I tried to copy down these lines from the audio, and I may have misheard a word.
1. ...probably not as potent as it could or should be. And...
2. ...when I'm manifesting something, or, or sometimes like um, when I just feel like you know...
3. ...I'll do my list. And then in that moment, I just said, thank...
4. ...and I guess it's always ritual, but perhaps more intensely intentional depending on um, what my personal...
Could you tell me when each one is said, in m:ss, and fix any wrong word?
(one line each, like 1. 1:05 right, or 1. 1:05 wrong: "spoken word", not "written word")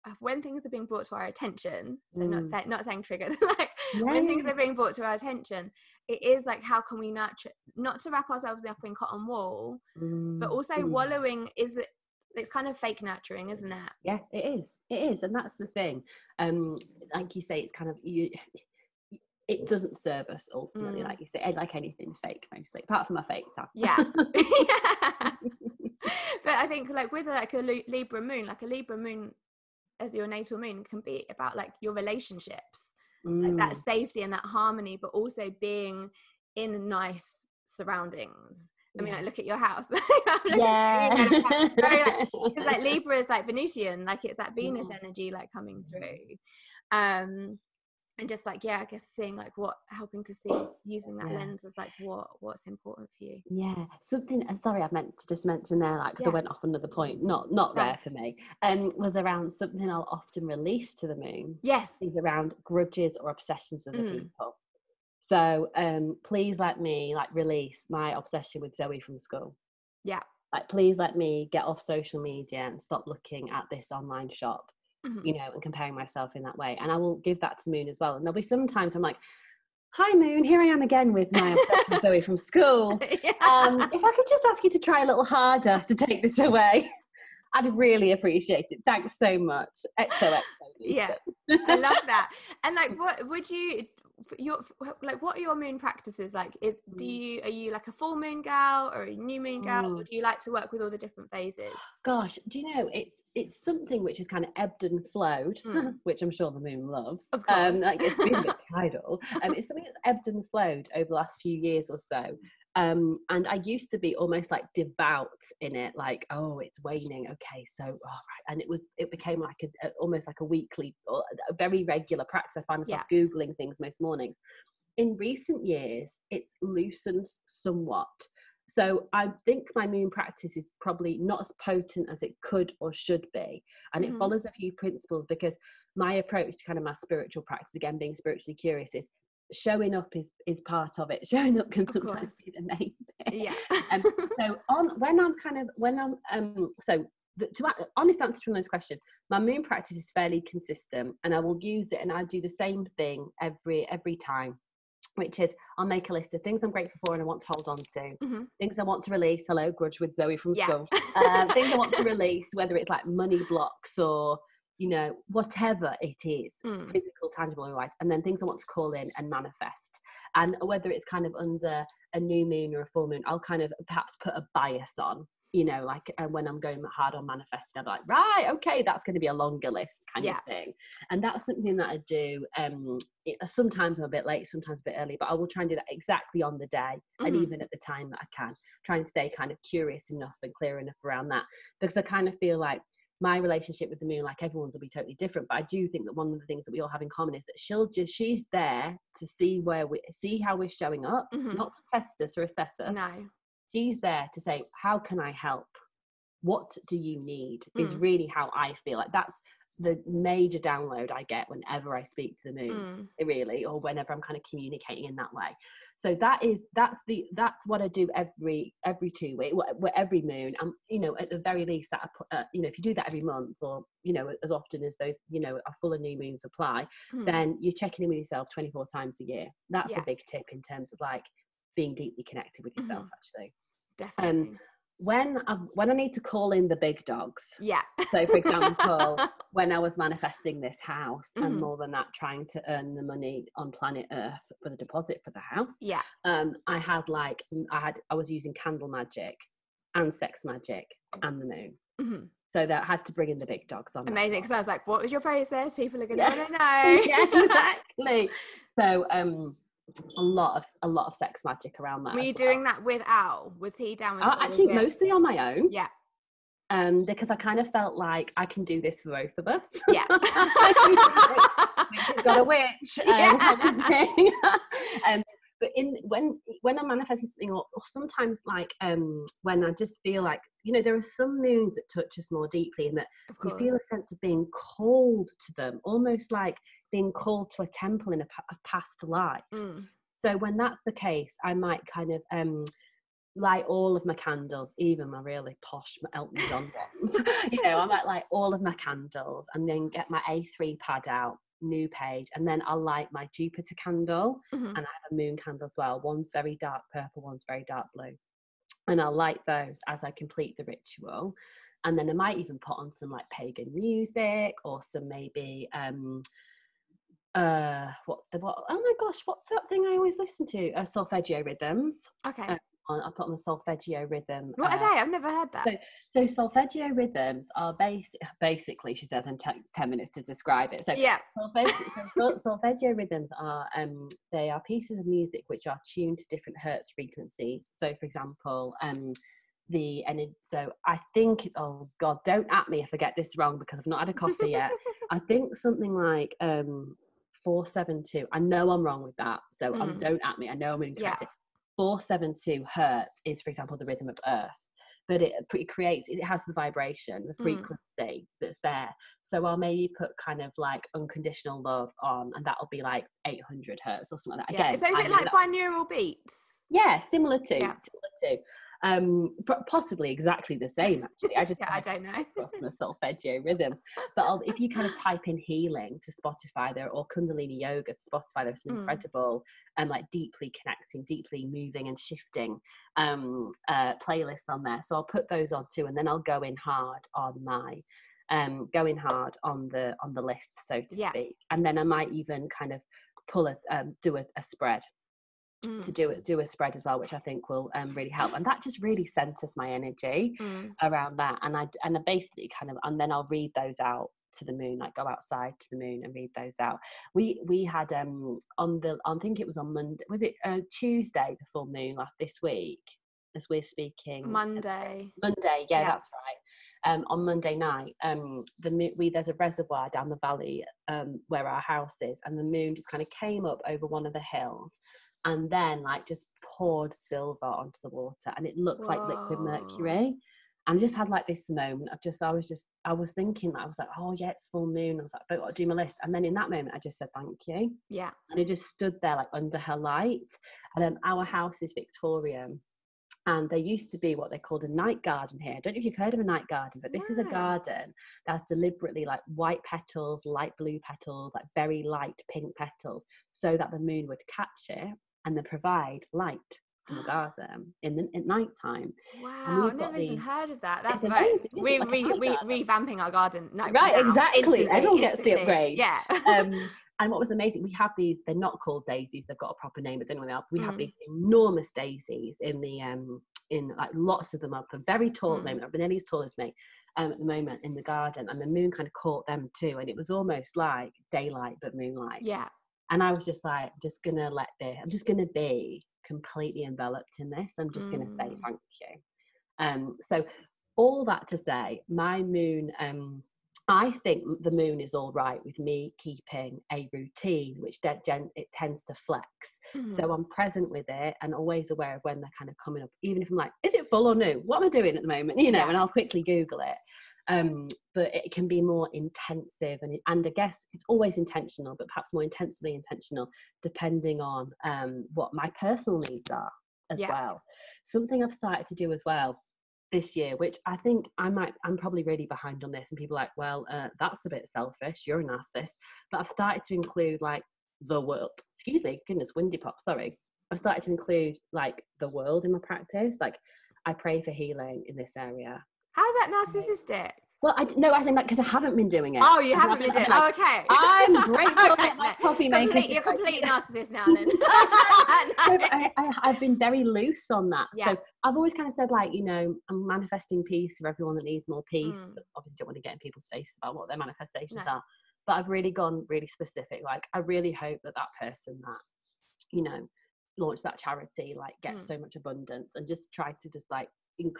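1. 2:10 right
2. 4:36 right
3. 7:15 right
4. 8:30 wrong: "intentional", not "ritual".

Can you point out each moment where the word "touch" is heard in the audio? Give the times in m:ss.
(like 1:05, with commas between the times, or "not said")
4:41.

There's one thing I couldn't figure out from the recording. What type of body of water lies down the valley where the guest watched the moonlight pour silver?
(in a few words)
Reservoir.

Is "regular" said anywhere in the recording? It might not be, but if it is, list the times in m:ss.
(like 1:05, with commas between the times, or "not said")
2:01.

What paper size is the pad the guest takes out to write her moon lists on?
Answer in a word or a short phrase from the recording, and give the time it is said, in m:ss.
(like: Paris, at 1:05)
A3, at 5:00.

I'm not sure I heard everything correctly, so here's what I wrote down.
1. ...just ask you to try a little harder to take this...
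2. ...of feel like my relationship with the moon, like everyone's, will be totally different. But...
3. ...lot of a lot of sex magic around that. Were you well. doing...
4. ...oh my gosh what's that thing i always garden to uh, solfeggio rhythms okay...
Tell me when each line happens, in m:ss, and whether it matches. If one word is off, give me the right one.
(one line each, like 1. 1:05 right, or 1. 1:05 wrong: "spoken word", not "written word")
1. 1:24 right
2. 3:12 right
3. 4:20 right
4. 5:18 wrong: "listen", not "garden".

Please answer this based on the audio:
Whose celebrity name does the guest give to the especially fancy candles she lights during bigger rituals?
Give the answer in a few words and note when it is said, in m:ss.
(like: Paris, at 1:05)
Elton John, at 4:56.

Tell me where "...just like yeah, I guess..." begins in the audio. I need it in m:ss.
0:48.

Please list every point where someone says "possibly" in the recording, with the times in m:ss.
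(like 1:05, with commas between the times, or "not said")
6:09.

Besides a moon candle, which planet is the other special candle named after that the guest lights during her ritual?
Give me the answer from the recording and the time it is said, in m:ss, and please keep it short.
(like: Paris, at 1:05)
Jupiter, at 5:03.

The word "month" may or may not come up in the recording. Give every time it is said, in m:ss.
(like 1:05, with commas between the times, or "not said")
3:43.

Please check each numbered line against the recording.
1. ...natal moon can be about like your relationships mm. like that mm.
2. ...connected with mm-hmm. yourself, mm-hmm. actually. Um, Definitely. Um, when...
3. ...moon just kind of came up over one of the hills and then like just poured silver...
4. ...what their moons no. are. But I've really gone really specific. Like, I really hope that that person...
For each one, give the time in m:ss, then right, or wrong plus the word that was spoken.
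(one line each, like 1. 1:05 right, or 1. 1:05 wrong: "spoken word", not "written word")
1. 0:30 right
2. 3:52 right
3. 7:02 right
4. 9:13 wrong: "manifestations", not "moons".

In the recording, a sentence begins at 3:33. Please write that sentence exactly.
really, or whenever I'm kind of communicating in that way.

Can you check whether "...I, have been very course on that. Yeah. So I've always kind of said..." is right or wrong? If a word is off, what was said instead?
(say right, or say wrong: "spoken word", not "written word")
wrong: "loose", not "course".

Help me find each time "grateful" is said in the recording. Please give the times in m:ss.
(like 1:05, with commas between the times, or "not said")
2:36, 9:01.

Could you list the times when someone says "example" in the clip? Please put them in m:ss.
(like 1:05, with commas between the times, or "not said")
3:58, 5:38, 5:53.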